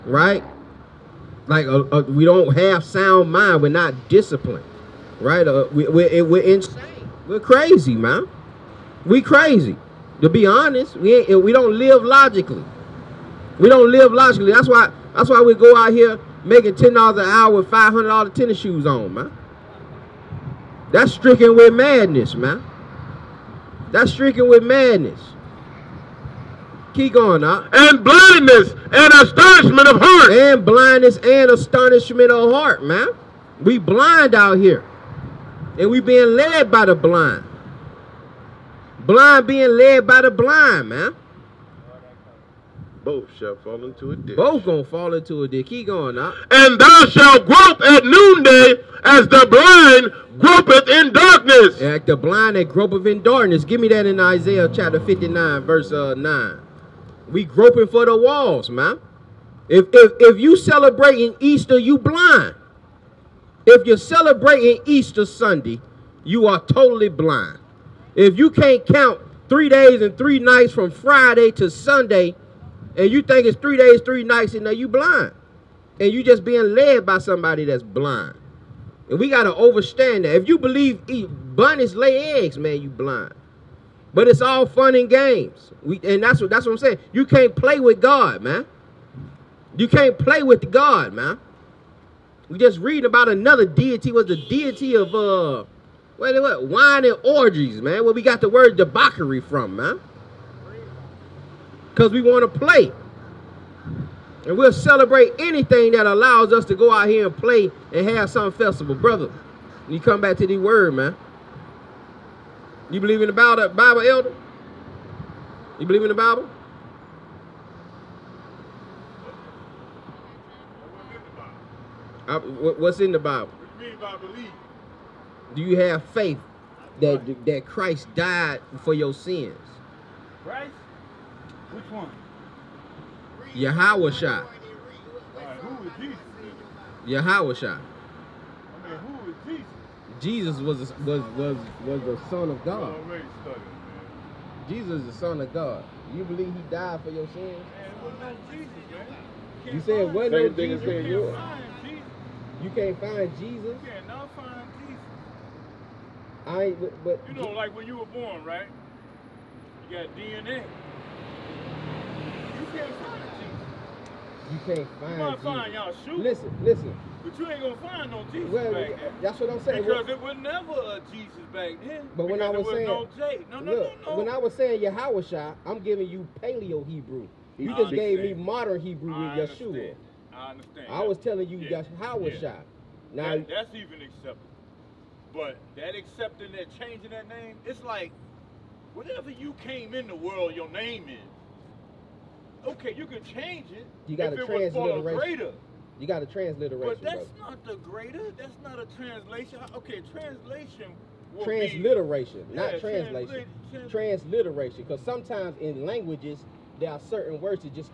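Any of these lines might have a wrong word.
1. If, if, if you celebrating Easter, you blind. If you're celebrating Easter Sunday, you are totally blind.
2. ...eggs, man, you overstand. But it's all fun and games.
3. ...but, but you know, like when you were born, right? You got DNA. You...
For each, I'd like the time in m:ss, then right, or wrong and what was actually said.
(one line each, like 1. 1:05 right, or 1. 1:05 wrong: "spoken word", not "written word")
1. 0:59 right
2. 1:22 wrong: "blind", not "overstand"
3. 2:36 right.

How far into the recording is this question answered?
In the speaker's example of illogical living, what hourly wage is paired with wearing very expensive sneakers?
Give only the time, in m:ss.
0:16.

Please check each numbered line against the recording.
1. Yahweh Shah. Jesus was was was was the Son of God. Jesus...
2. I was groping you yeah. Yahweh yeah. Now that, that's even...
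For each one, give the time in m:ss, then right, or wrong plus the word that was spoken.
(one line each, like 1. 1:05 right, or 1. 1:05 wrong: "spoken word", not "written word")
1. 2:17 right
2. 3:00 wrong: "telling", not "groping".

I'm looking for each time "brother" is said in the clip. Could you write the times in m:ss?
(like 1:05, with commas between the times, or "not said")
1:48, 3:17.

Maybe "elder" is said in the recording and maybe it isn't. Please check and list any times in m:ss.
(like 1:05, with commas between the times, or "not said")
1:54.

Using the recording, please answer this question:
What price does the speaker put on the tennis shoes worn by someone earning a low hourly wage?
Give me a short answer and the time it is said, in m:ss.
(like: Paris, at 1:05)
$500, at 0:17.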